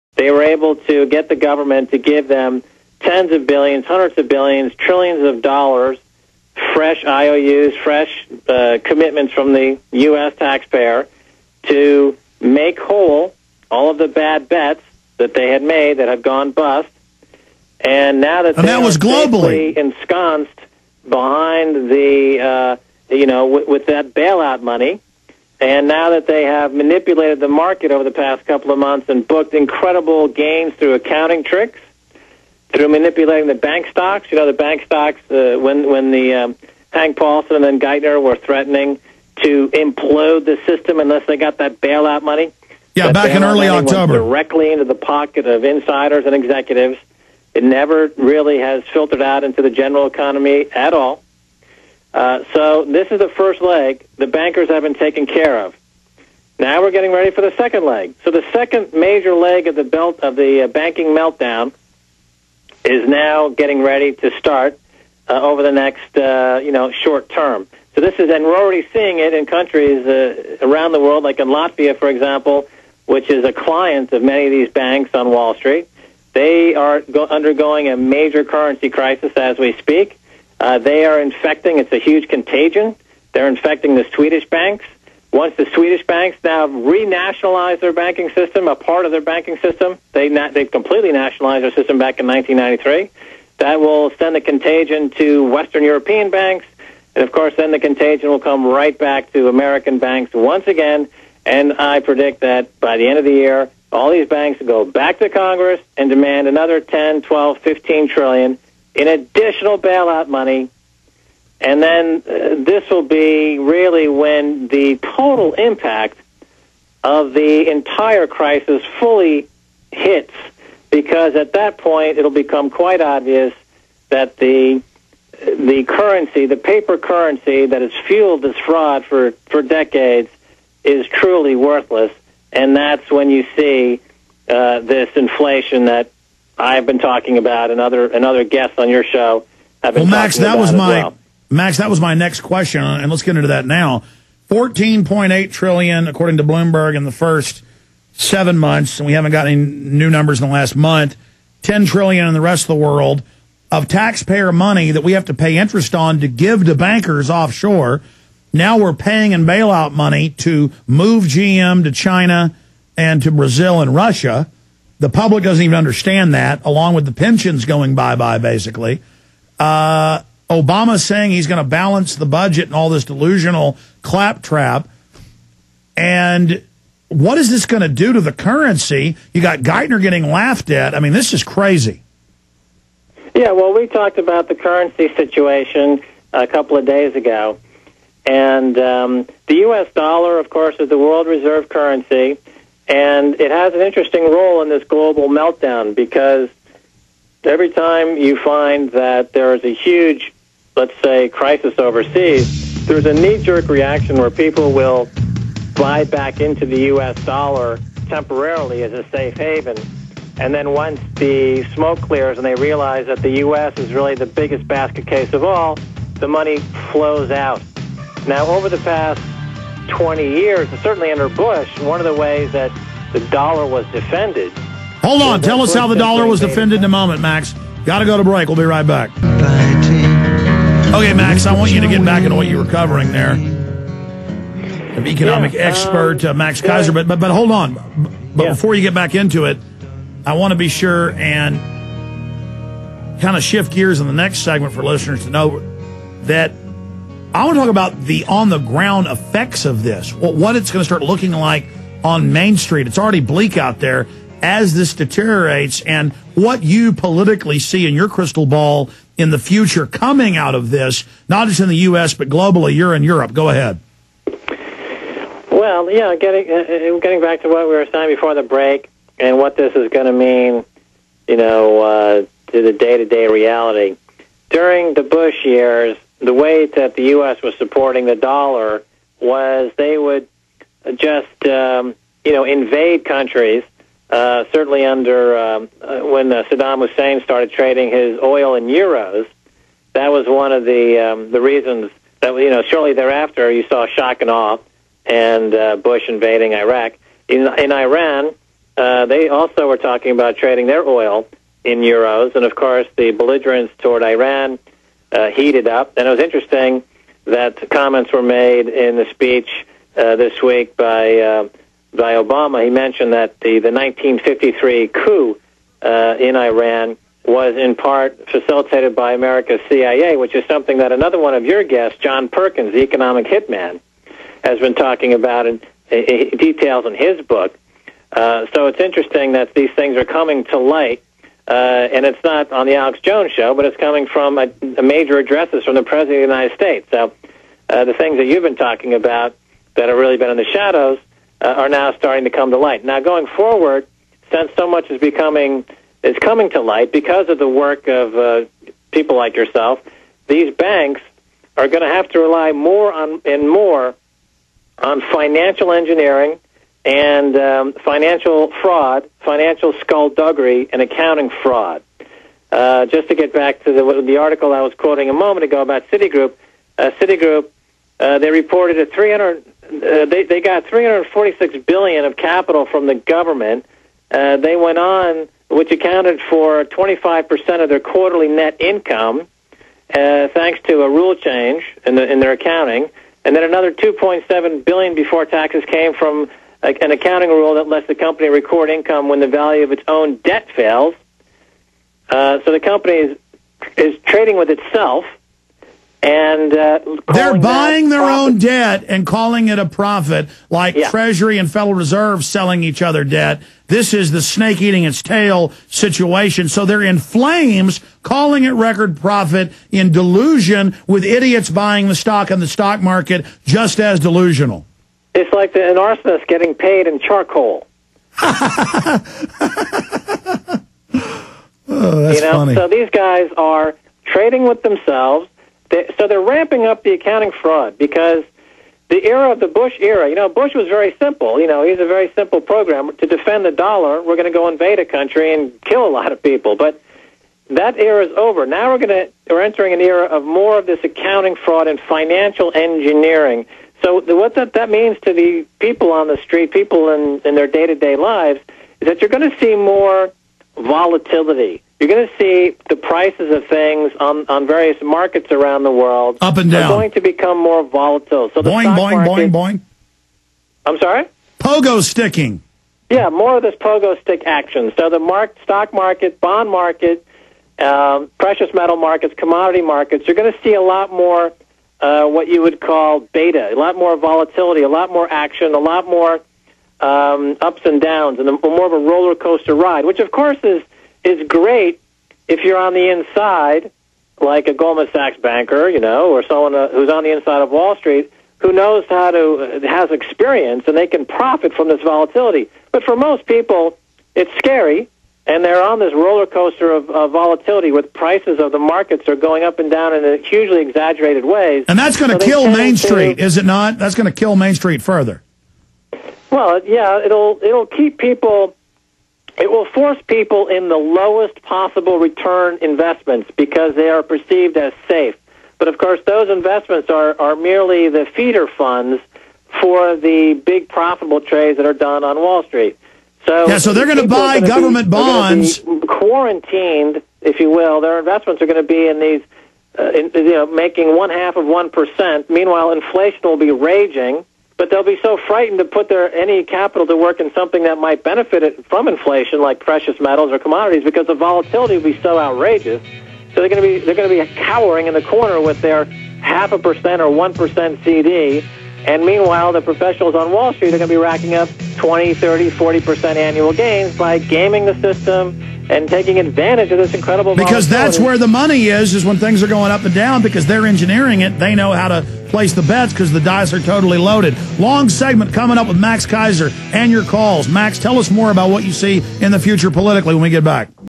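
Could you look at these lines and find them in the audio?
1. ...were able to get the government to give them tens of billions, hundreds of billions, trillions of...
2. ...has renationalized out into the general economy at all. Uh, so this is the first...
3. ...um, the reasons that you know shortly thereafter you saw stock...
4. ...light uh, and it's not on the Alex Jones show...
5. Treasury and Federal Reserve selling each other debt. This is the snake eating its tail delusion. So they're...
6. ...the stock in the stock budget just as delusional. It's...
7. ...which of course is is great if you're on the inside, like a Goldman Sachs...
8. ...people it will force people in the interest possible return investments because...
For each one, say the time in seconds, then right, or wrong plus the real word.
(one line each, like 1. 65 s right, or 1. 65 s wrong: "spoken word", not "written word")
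1. 0 s right
2. 48 s wrong: "filtered", not "renationalized"
3. 290 s wrong: "shock", not "stock"
4. 330 s right
5. 400 s wrong: "situation", not "delusion"
6. 411 s wrong: "market", not "budget"
7. 479 s right
8. 507 s wrong: "lowest", not "interest".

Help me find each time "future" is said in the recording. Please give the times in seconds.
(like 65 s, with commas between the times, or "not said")
259 s, 569 s.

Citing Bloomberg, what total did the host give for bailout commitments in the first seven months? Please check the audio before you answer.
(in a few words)
14.8 trillion.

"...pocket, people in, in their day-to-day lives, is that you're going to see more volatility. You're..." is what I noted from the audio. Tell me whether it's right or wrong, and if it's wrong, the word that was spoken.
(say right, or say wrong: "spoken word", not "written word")
wrong: "street", not "pocket".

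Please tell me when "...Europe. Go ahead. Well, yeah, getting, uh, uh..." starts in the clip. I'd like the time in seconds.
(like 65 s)
263 s.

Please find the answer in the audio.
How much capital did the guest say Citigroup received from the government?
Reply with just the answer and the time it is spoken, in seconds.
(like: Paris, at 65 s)
346 billion, at 370 s.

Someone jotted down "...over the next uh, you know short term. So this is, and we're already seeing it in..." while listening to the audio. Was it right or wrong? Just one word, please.
right.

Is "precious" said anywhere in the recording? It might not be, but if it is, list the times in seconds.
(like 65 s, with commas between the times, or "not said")
468 s, 539 s.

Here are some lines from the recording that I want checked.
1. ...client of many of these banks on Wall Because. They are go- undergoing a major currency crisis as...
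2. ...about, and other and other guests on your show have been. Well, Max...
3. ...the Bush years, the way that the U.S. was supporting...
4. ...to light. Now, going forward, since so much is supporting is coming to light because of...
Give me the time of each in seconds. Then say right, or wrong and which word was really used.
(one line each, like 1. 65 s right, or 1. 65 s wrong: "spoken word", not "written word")
1. 73 s wrong: "Street", not "Because"
2. 137 s right
3. 274 s right
4. 342 s wrong: "becoming", not "supporting".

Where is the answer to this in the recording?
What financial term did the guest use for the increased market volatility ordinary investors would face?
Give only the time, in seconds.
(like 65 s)
472 s.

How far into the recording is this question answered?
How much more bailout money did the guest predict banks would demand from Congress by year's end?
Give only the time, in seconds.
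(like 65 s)
106 s.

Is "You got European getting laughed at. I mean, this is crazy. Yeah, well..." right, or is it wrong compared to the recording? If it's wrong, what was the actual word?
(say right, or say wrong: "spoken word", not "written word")
wrong: "Geithner", not "European".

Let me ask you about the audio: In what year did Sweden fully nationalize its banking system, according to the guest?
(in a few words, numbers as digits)
1993.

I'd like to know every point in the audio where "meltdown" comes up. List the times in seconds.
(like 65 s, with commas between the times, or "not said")
61 s, 195 s.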